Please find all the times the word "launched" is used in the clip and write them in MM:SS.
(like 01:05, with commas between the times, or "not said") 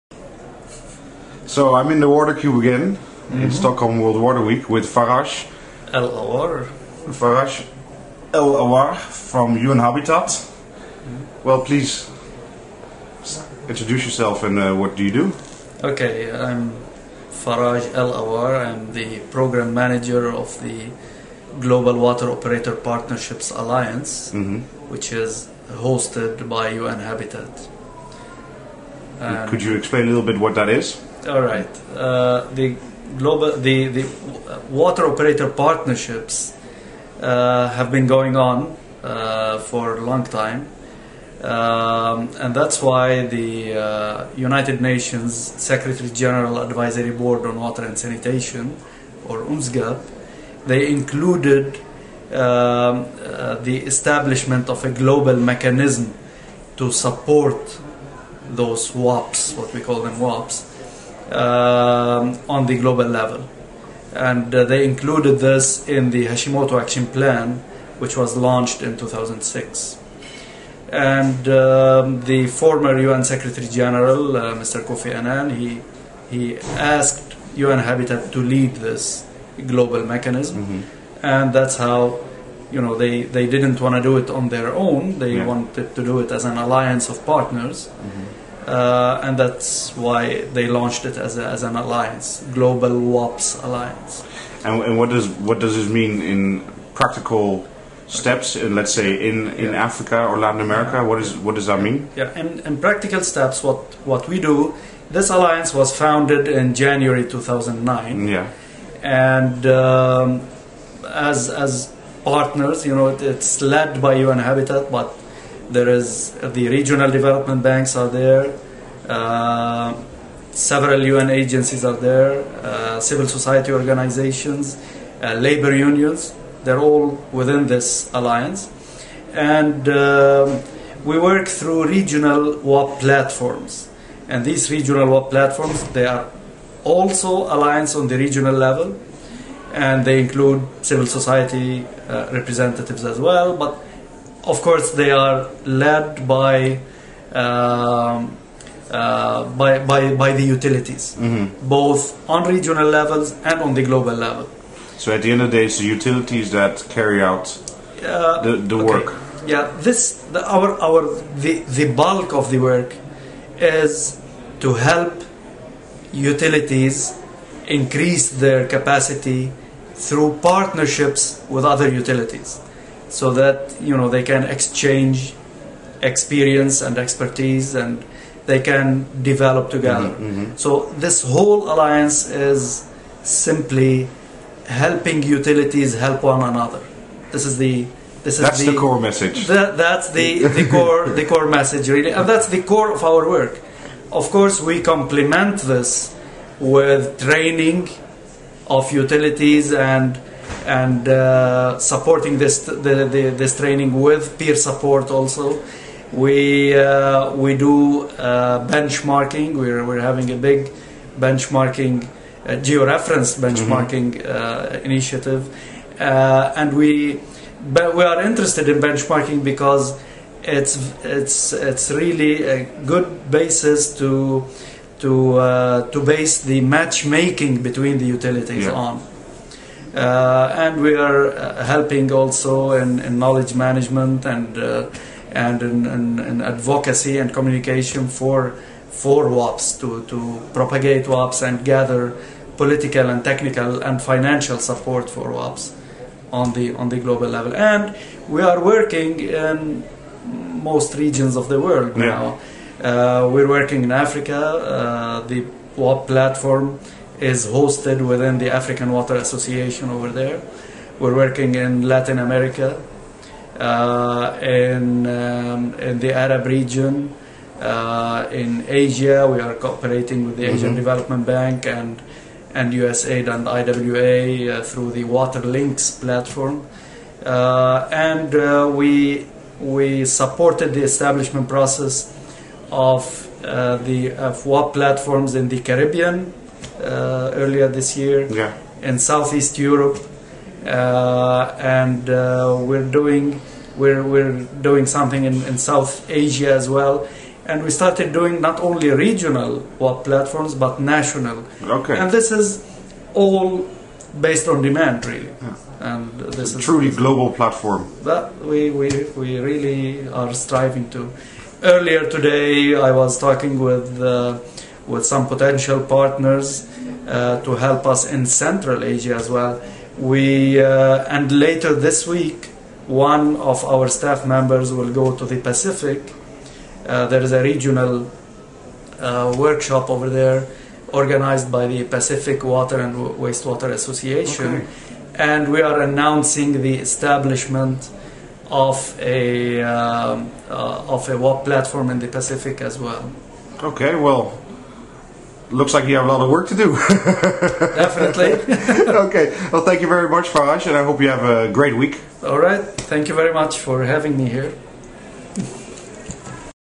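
01:08, 01:30.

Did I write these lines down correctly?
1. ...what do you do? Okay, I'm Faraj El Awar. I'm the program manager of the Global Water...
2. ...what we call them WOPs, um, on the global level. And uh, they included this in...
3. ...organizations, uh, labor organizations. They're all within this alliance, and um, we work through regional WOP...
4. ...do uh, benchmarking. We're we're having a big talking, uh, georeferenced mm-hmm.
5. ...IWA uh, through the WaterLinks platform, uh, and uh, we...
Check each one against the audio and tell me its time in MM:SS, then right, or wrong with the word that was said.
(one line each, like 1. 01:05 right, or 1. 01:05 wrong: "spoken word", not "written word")
1. 00:14 right
2. 00:59 right
3. 02:03 wrong: "unions", not "organizations"
4. 03:27 wrong: "benchmarking", not "talking"
5. 04:33 right.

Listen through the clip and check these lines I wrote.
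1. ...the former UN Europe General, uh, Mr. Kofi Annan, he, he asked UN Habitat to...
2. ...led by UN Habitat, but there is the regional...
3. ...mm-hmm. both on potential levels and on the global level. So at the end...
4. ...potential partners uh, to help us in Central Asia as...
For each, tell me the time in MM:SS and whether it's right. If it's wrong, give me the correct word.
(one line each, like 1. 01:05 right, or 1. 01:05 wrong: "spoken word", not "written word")
1. 01:12 wrong: "Secretary", not "Europe"
2. 01:53 right
3. 02:31 wrong: "regional", not "potential"
4. 05:15 right.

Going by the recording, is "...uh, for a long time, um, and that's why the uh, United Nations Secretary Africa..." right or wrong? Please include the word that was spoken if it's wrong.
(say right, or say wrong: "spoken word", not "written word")
wrong: "General", not "Africa".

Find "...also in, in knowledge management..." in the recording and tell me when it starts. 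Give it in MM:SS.
03:52.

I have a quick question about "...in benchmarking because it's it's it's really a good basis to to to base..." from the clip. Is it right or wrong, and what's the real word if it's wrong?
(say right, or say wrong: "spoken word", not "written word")
right.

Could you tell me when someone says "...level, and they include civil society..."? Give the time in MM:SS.
02:18.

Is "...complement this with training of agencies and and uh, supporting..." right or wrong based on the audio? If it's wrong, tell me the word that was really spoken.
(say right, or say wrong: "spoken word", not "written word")
wrong: "utilities", not "agencies".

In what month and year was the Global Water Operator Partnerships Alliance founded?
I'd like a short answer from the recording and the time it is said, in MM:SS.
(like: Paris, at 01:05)
January 2009, at 01:46.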